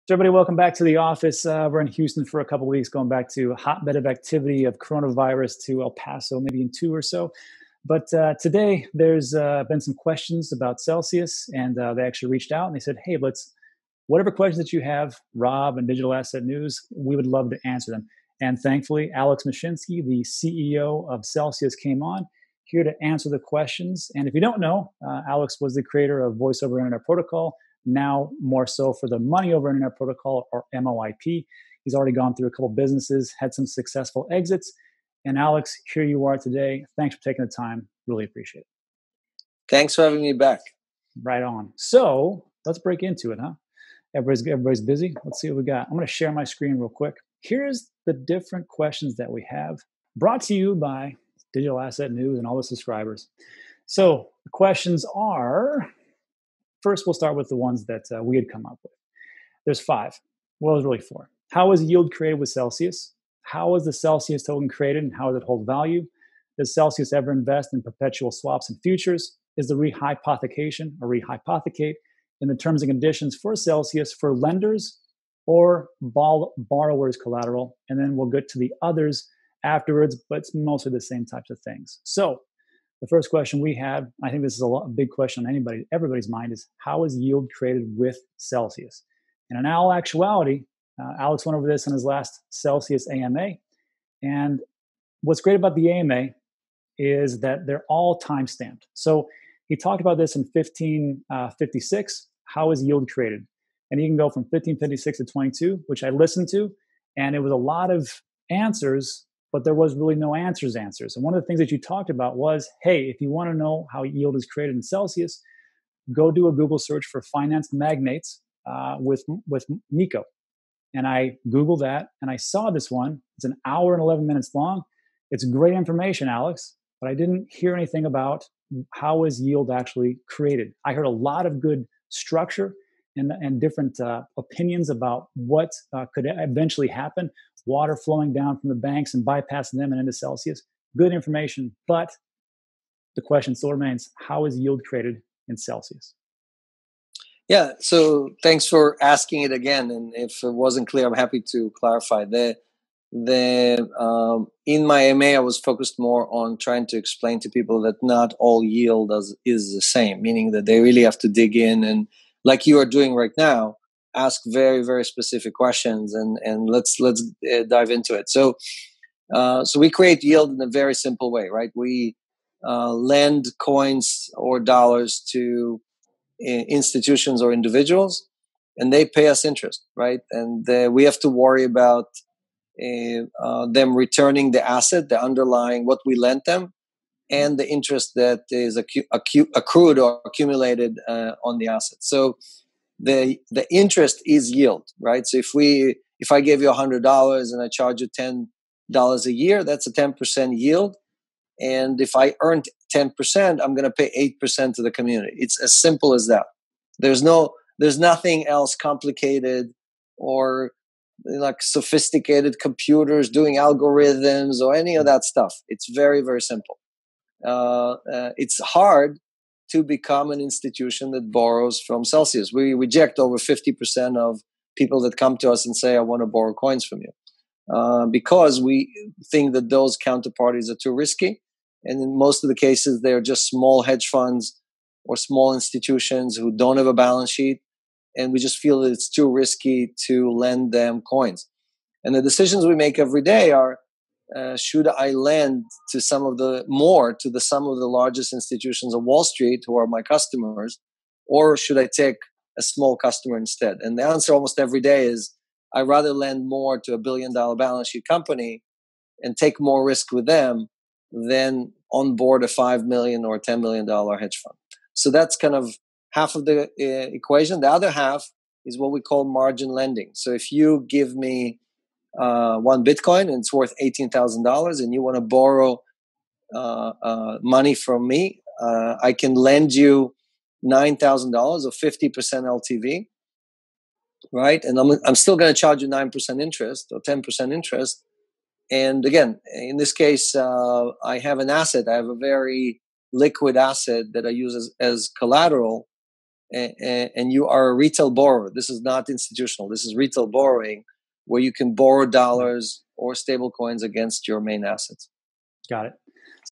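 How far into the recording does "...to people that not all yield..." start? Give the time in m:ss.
2:37.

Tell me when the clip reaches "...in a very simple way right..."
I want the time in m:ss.
2:50.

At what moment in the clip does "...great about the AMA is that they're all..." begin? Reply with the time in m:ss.
1:35.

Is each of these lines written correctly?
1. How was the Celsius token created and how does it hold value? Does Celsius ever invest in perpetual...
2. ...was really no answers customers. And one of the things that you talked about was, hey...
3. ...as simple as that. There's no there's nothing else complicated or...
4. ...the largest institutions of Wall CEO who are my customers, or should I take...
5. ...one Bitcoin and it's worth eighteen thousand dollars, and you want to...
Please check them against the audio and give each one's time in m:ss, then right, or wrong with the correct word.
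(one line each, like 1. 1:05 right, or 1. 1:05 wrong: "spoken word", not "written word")
1. 1:03 right
2. 1:49 wrong: "answers", not "customers"
3. 3:25 right
4. 4:07 wrong: "Street", not "CEO"
5. 4:32 right.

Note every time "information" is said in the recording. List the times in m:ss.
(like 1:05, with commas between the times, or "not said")
2:05, 2:21.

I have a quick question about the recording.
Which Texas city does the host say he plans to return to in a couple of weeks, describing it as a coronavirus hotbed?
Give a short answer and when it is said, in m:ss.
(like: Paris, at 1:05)
El Paso, at 0:05.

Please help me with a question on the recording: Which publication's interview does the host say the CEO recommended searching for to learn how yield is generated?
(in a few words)
Finance Magnates.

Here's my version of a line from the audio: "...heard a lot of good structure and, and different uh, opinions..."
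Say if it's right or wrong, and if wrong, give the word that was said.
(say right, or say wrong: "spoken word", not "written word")
right.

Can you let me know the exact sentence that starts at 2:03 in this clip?
It's an hour and 11 minutes long.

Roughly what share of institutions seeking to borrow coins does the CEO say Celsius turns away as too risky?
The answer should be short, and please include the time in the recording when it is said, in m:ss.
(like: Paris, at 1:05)
over 50%, at 3:43.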